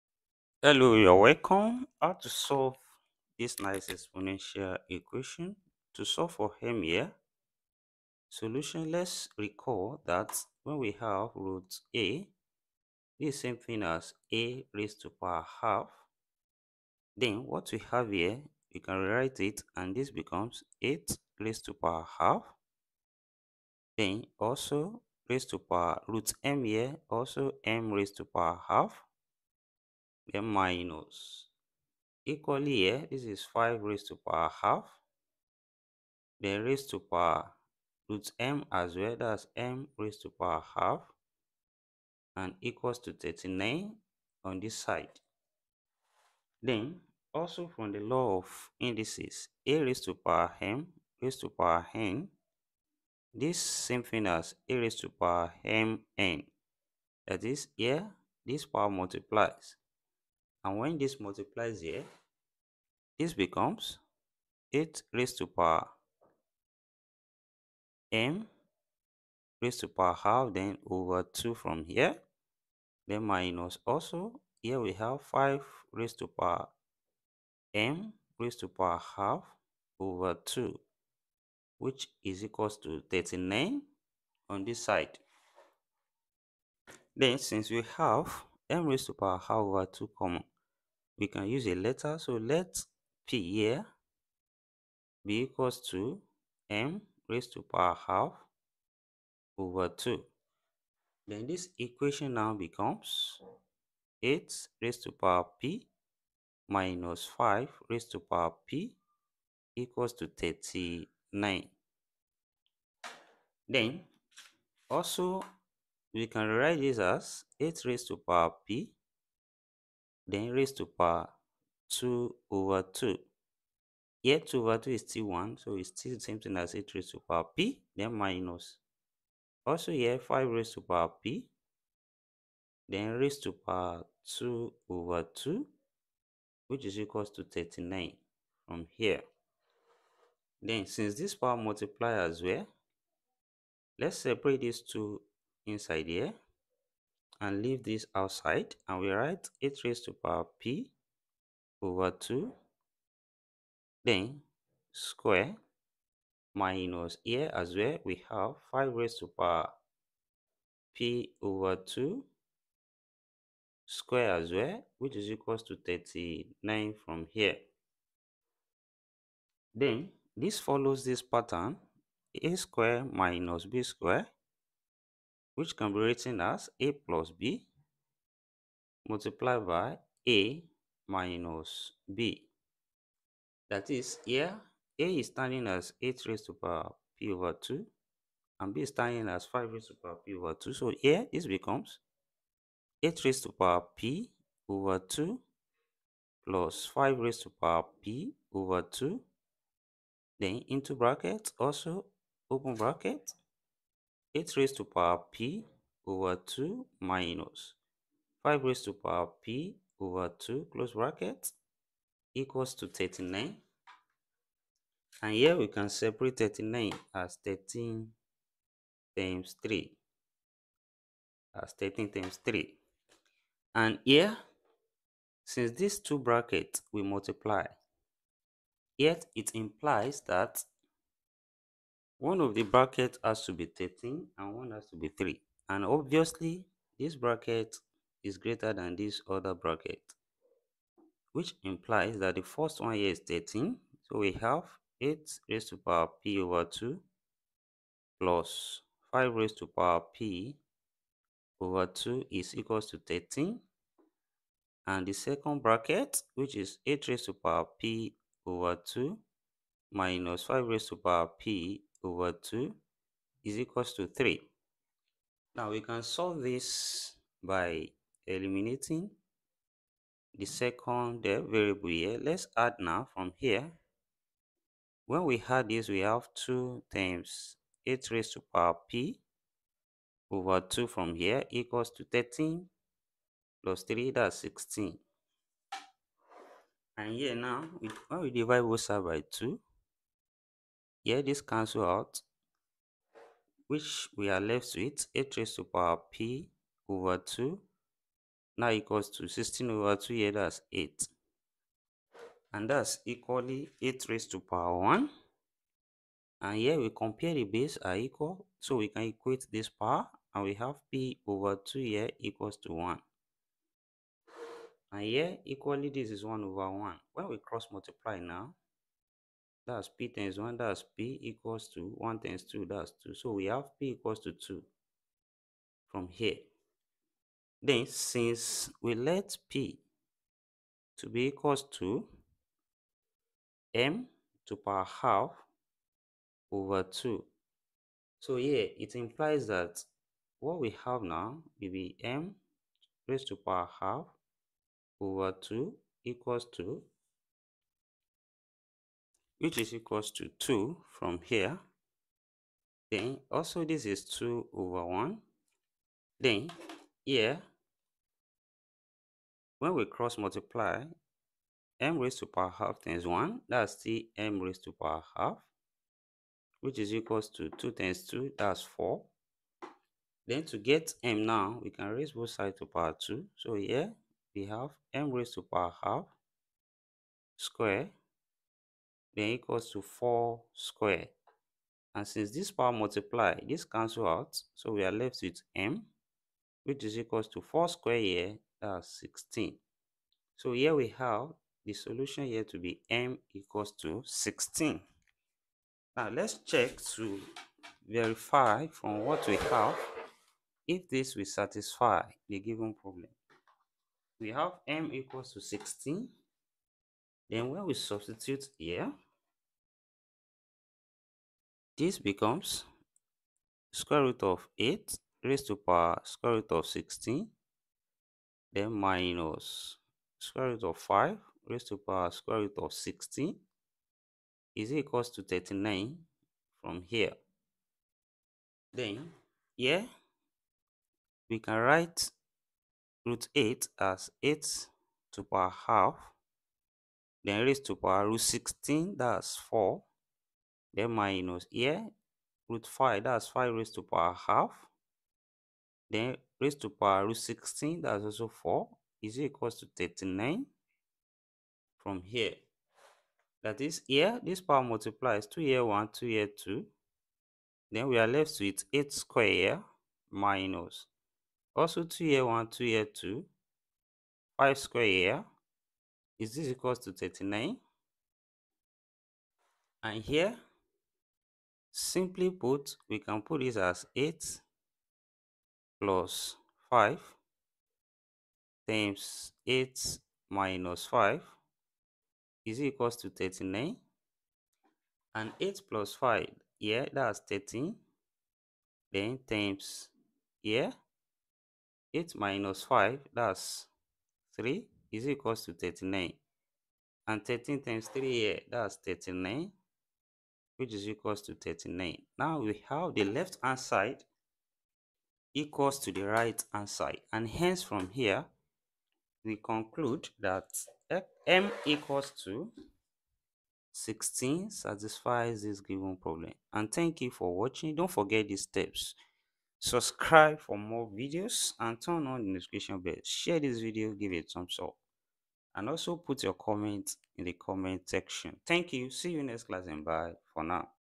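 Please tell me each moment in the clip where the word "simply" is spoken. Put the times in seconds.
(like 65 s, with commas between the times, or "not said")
471 s.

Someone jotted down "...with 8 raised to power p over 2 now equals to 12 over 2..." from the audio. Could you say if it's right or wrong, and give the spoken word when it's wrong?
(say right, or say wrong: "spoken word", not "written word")
wrong: "16", not "12".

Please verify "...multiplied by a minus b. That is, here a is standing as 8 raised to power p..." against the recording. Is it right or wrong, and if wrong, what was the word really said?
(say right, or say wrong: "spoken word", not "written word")
right.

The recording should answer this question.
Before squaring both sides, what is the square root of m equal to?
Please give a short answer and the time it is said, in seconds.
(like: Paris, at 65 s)
4, at 367 s.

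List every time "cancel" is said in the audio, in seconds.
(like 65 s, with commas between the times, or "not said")
291 s, 383 s.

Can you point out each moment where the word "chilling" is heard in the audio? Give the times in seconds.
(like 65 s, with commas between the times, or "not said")
not said.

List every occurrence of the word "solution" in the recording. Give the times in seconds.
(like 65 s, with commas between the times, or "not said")
8 s, 391 s.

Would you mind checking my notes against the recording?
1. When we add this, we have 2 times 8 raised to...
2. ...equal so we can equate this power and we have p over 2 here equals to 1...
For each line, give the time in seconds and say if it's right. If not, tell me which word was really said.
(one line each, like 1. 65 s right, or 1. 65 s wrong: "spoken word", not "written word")
1. 275 s right
2. 307 s right.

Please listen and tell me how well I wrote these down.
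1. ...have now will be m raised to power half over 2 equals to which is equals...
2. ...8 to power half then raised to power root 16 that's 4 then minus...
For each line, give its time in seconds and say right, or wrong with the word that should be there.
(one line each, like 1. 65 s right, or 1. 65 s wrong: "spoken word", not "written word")
1. 340 s right
2. 434 s right.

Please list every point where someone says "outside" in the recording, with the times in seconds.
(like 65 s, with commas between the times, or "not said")
148 s.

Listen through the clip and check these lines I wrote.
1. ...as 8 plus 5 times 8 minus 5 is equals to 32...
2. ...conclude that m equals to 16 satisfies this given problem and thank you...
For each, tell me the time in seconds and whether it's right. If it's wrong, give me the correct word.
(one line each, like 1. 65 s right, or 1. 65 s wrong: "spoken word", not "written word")
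1. 473 s wrong: "39", not "32"
2. 509 s right.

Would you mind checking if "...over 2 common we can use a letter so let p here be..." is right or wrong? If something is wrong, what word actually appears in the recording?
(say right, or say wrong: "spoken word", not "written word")
right.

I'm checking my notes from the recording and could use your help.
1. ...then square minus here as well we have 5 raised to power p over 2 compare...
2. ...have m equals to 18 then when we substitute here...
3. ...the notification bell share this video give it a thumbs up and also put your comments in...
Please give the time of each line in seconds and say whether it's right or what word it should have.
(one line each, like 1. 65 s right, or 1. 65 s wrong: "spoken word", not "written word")
1. 154 s wrong: "square", not "compare"
2. 404 s wrong: "16", not "18"
3. 522 s right.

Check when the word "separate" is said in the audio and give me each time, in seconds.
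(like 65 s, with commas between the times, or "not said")
144 s, 215 s.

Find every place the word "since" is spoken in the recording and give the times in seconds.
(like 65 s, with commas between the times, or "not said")
87 s, 140 s, 225 s, 327 s, 382 s.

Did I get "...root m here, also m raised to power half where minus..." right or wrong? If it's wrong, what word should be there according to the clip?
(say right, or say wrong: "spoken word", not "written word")
right.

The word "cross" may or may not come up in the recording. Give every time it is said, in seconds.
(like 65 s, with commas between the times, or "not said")
317 s, 359 s.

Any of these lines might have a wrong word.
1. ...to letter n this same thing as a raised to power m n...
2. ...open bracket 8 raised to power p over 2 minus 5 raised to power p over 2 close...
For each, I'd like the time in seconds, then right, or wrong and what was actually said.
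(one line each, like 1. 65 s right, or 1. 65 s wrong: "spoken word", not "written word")
1. 51 s wrong: "power", not "letter"
2. 202 s right.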